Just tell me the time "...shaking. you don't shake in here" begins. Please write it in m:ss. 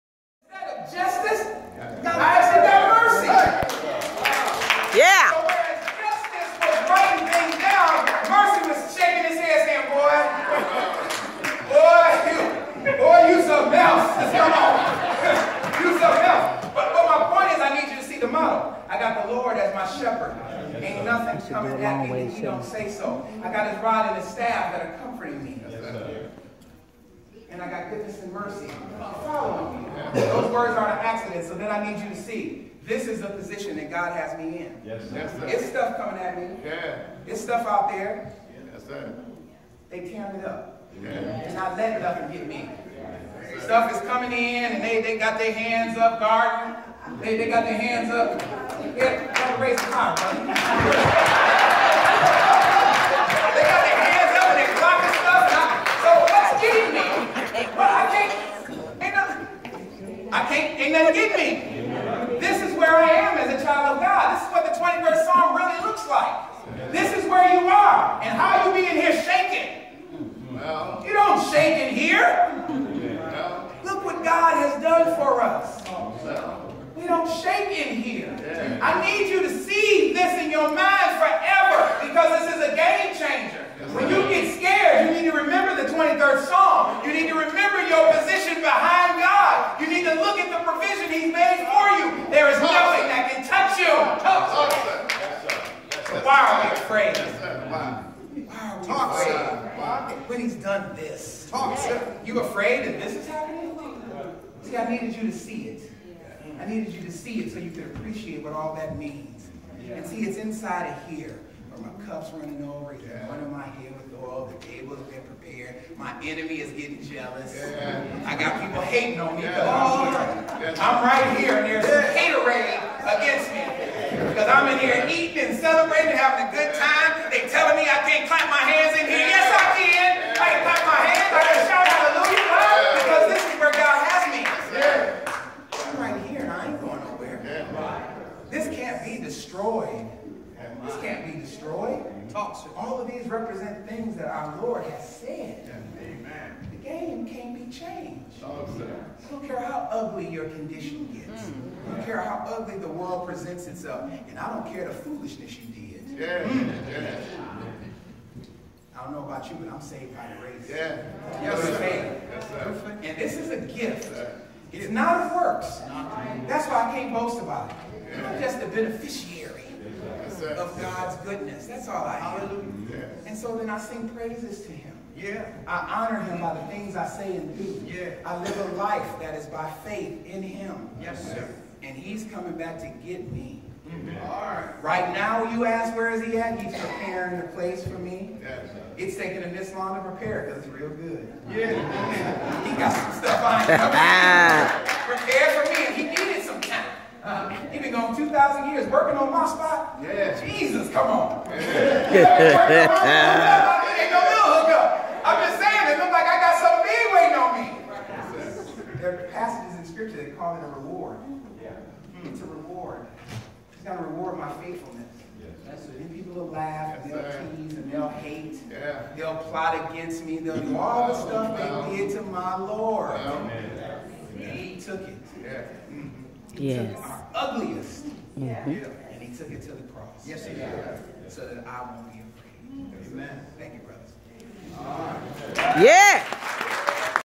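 1:09.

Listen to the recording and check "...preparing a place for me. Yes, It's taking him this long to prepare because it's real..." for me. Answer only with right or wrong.
right.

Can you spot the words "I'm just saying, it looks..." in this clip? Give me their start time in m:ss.
3:25.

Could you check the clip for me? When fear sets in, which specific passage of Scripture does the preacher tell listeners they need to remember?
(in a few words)
23rd Psalm.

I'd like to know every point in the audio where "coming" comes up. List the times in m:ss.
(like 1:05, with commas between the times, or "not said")
0:21, 0:35, 0:44, 3:02.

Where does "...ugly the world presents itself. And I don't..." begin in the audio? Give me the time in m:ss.
2:32.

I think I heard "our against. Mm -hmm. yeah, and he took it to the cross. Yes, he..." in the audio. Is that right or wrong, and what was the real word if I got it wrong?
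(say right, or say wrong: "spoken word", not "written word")
wrong: "ugliest", not "against".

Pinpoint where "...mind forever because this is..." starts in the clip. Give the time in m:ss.
1:20.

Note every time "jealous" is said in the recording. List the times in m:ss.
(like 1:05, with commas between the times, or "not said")
1:57.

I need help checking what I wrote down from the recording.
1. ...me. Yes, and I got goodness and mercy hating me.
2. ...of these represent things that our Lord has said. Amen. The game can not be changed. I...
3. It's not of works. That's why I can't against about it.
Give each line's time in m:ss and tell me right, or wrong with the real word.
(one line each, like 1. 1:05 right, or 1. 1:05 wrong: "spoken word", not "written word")
1. 0:25 wrong: "following", not "hating"
2. 2:22 right
3. 2:44 wrong: "boast", not "against".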